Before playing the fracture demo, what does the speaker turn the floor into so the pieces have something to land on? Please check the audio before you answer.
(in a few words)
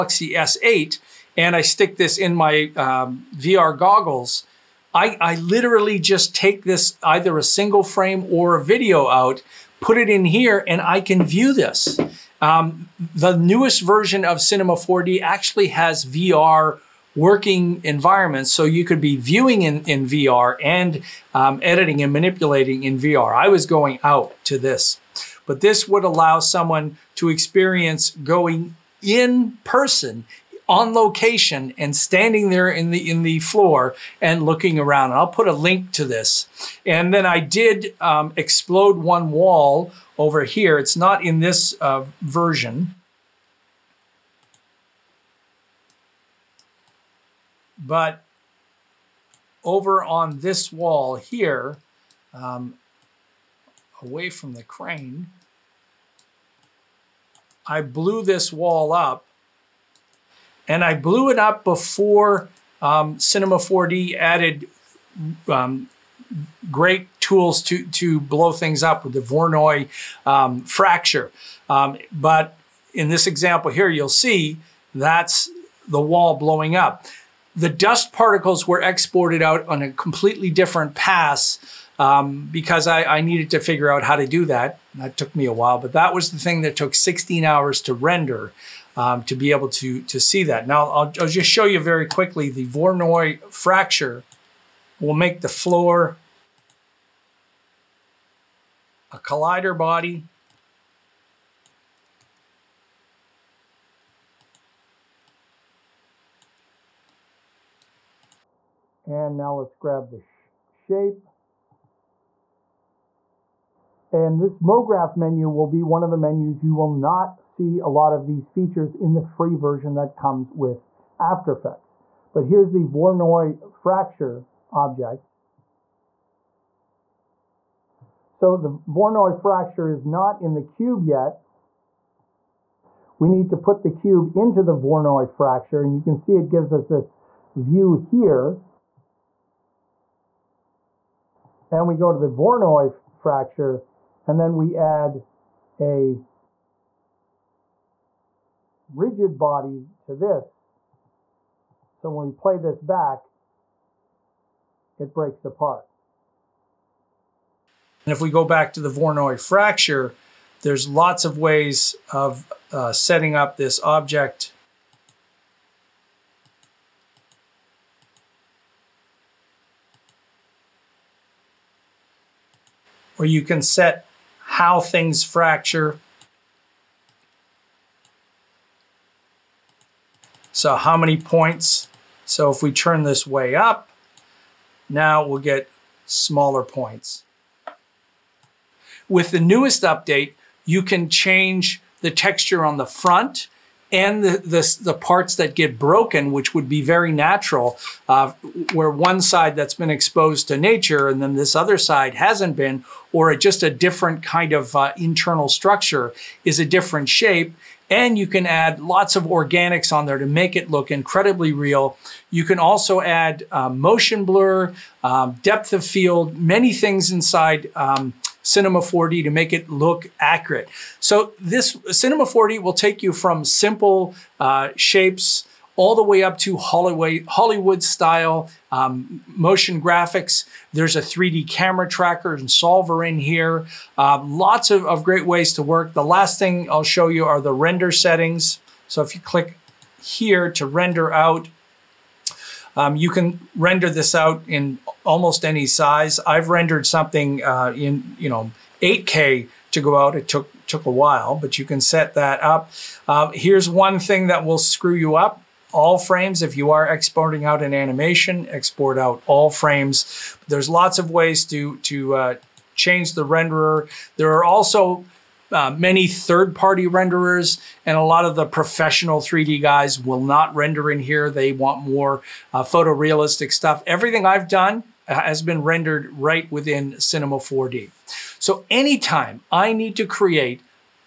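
collider body.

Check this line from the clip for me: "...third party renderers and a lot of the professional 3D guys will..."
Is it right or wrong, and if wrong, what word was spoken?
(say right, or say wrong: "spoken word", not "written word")
right.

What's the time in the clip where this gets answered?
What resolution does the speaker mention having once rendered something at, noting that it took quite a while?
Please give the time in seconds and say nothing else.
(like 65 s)
248 s.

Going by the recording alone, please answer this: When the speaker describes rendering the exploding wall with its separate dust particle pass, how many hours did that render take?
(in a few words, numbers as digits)
16.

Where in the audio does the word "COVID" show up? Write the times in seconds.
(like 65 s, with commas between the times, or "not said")
not said.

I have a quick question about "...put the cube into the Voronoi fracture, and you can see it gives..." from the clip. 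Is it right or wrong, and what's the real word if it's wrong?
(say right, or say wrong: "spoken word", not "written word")
right.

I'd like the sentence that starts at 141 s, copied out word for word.
And we go to the Voronoi fracture, and then we add a rigid body to this.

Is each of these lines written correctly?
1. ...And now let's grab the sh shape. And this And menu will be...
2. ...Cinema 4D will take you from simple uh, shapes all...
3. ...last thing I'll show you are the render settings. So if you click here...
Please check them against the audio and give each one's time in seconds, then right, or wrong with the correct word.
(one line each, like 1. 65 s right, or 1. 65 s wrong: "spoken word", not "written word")
1. 109 s wrong: "MoGraph", not "And"
2. 221 s right
3. 236 s right.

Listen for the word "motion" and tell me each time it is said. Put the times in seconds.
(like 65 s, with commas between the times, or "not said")
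213 s, 229 s.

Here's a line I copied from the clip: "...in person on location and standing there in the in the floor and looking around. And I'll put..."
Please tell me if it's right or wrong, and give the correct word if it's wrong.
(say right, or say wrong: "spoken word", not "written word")
right.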